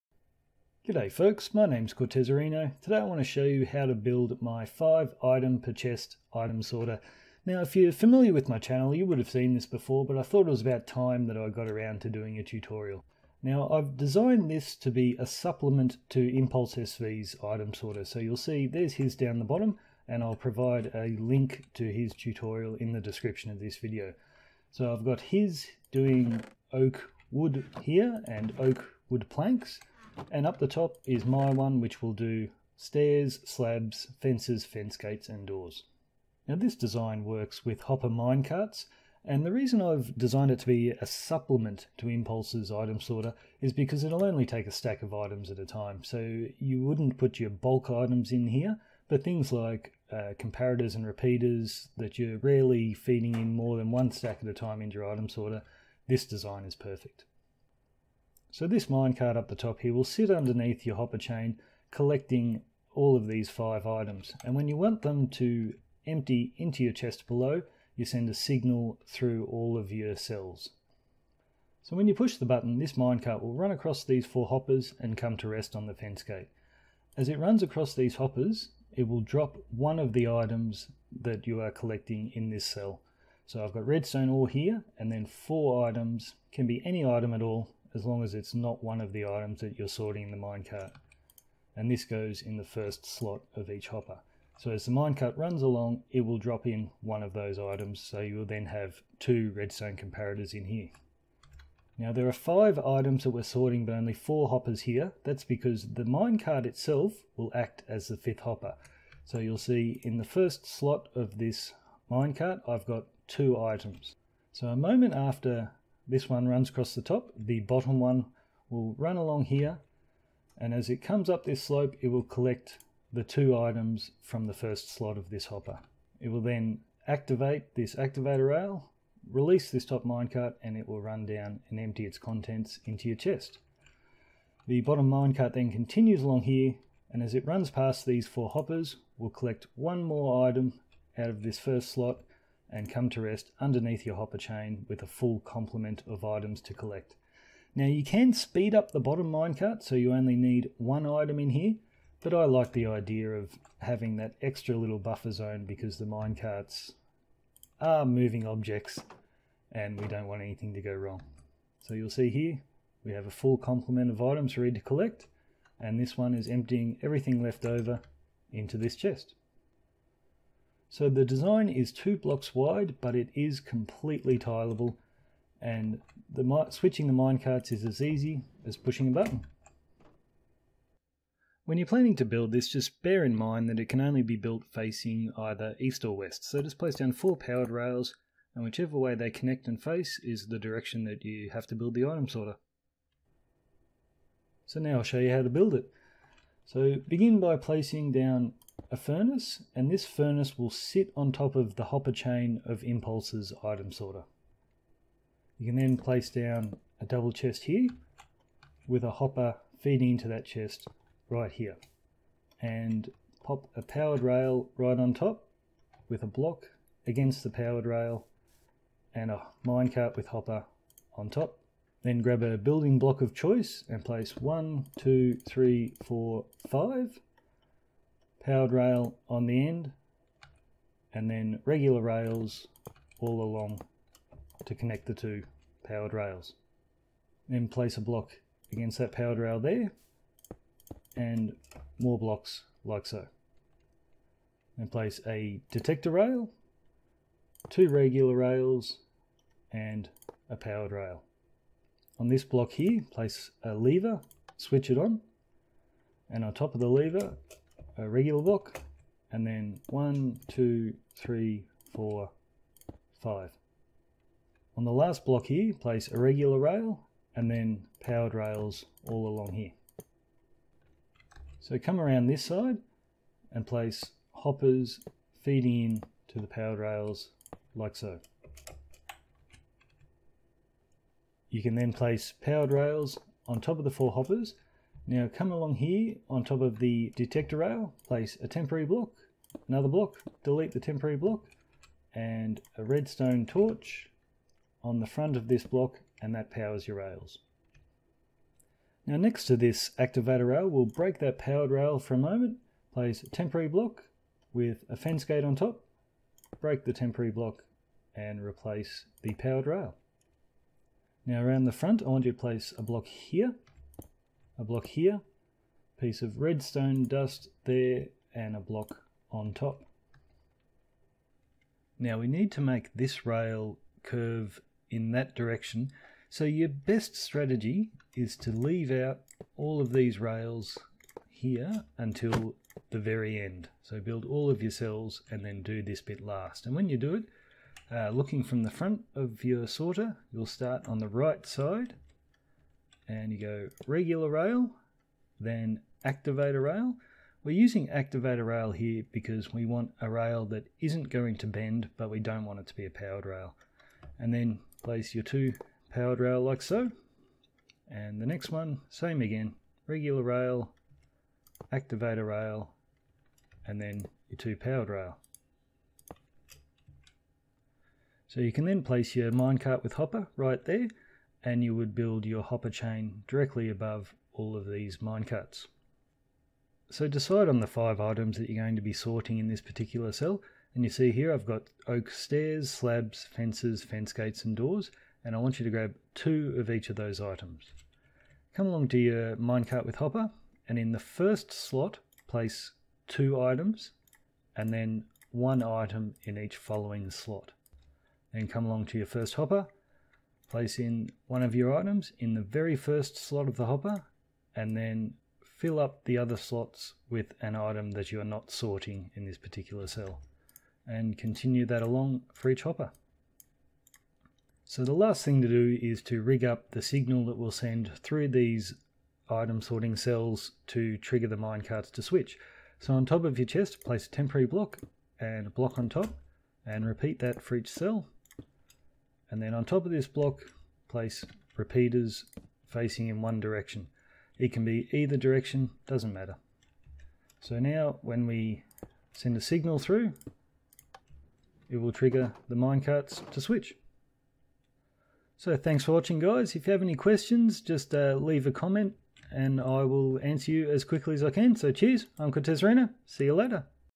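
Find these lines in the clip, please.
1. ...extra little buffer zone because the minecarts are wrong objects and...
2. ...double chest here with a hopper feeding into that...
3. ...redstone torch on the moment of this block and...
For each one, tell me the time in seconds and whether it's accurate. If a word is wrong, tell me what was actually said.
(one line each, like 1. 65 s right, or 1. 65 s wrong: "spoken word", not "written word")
1. 154 s wrong: "moving", not "wrong"
2. 207 s right
3. 292 s wrong: "front", not "moment".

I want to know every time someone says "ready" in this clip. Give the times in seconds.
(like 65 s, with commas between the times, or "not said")
164 s.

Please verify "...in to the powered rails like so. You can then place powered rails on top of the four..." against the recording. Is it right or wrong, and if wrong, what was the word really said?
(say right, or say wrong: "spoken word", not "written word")
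right.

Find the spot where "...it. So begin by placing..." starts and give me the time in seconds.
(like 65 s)
195 s.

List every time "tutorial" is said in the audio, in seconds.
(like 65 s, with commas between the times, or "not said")
12 s, 22 s.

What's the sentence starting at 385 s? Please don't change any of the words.
And I want you to grab two of each of those items.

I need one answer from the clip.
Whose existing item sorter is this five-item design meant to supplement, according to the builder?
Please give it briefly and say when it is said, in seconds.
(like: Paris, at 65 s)
impulseSV, at 16 s.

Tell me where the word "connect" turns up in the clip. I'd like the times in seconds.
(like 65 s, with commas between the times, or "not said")
189 s, 234 s.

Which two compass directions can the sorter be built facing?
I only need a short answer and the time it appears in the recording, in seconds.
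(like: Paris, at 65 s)
east or west, at 185 s.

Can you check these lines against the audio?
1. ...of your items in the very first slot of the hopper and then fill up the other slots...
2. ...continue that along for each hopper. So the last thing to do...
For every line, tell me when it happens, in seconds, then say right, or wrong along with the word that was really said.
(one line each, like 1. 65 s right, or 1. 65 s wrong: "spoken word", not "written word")
1. 401 s right
2. 411 s right.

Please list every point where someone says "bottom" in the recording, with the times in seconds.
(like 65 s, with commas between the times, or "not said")
19 s, 117 s, 134 s, 148 s.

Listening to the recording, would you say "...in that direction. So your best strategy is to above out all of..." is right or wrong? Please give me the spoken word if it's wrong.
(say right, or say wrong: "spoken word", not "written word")
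wrong: "leave", not "above".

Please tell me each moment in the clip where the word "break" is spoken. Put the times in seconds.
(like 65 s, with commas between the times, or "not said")
300 s, 306 s.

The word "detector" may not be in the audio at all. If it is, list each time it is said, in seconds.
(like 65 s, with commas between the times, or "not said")
245 s, 287 s.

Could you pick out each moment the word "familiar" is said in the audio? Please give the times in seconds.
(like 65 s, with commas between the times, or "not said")
7 s.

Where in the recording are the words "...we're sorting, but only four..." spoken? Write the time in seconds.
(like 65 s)
103 s.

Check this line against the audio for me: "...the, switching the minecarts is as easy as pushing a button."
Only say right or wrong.
right.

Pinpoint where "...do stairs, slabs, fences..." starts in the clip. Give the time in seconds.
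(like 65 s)
32 s.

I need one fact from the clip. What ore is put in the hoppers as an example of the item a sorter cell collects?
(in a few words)
redstone ore.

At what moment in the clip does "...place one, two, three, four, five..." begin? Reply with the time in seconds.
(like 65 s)
224 s.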